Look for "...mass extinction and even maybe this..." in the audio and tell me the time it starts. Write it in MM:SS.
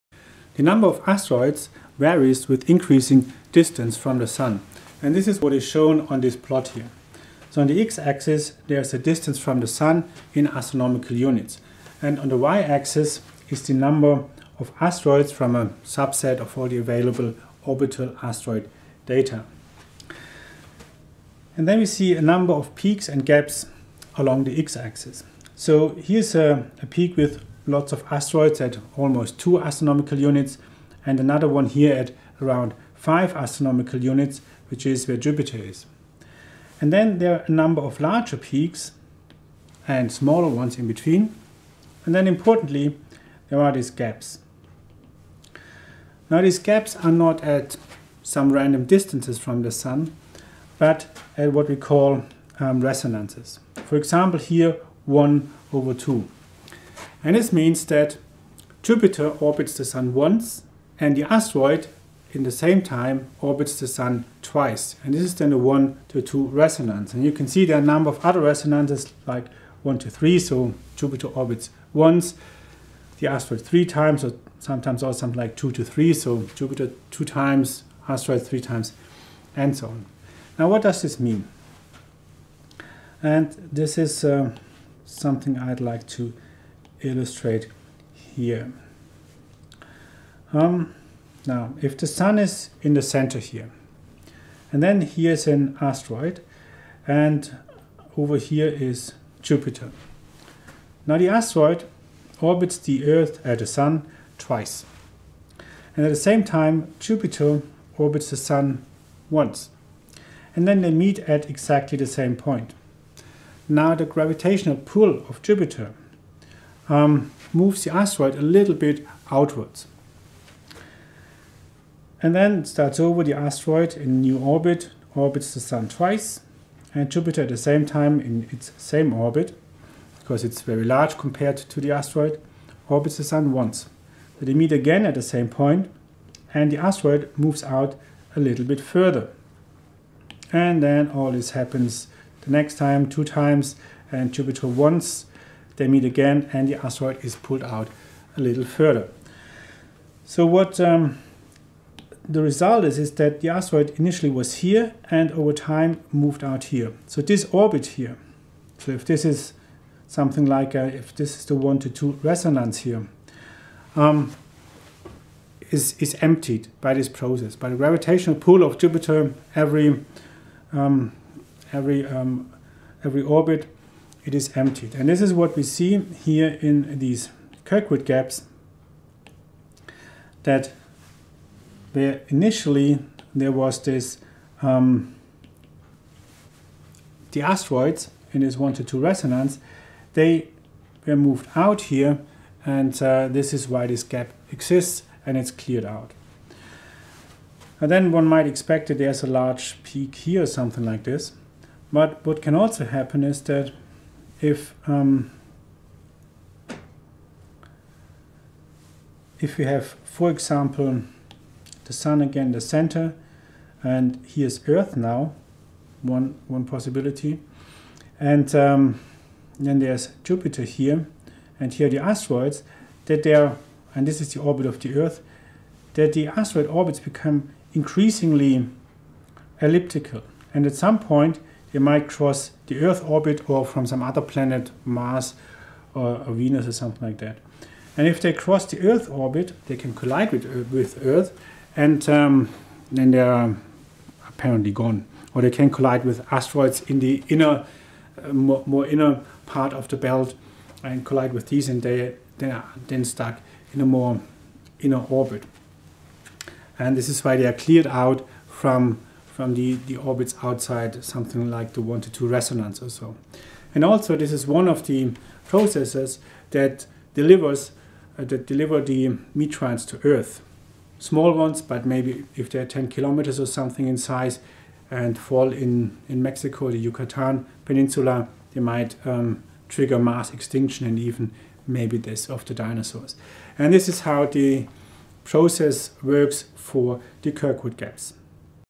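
04:39.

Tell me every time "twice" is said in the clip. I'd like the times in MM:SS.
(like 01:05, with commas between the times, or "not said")
01:04, 01:44, 02:05.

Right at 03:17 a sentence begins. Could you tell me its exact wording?
And then one might expect that there's a large peak here or something like this.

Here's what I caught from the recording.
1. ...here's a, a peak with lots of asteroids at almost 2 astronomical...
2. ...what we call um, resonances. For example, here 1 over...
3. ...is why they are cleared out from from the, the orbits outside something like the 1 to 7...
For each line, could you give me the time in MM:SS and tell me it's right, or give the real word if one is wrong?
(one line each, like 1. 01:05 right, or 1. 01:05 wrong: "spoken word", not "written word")
1. 00:25 right
2. 00:51 right
3. 04:17 wrong: "2", not "7".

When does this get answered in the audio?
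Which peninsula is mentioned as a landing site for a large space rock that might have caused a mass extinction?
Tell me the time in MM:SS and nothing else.
04:36.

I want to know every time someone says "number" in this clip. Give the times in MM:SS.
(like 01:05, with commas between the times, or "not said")
00:00, 00:13, 00:22, 00:37, 01:07.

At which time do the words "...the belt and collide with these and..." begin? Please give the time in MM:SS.
04:09.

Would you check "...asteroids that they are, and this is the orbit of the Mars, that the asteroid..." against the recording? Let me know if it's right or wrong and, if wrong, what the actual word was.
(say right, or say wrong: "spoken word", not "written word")
wrong: "Earth", not "Mars".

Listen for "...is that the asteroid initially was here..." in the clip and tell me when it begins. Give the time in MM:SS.
02:32.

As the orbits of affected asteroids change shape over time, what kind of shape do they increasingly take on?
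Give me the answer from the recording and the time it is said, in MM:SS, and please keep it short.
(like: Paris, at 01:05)
elliptical, at 03:49.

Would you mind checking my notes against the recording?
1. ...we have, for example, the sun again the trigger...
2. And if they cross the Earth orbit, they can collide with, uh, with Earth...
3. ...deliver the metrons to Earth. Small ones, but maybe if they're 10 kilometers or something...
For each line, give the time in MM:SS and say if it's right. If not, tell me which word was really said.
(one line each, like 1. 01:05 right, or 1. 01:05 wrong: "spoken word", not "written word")
1. 03:29 wrong: "center", not "trigger"
2. 03:57 right
3. 04:28 right.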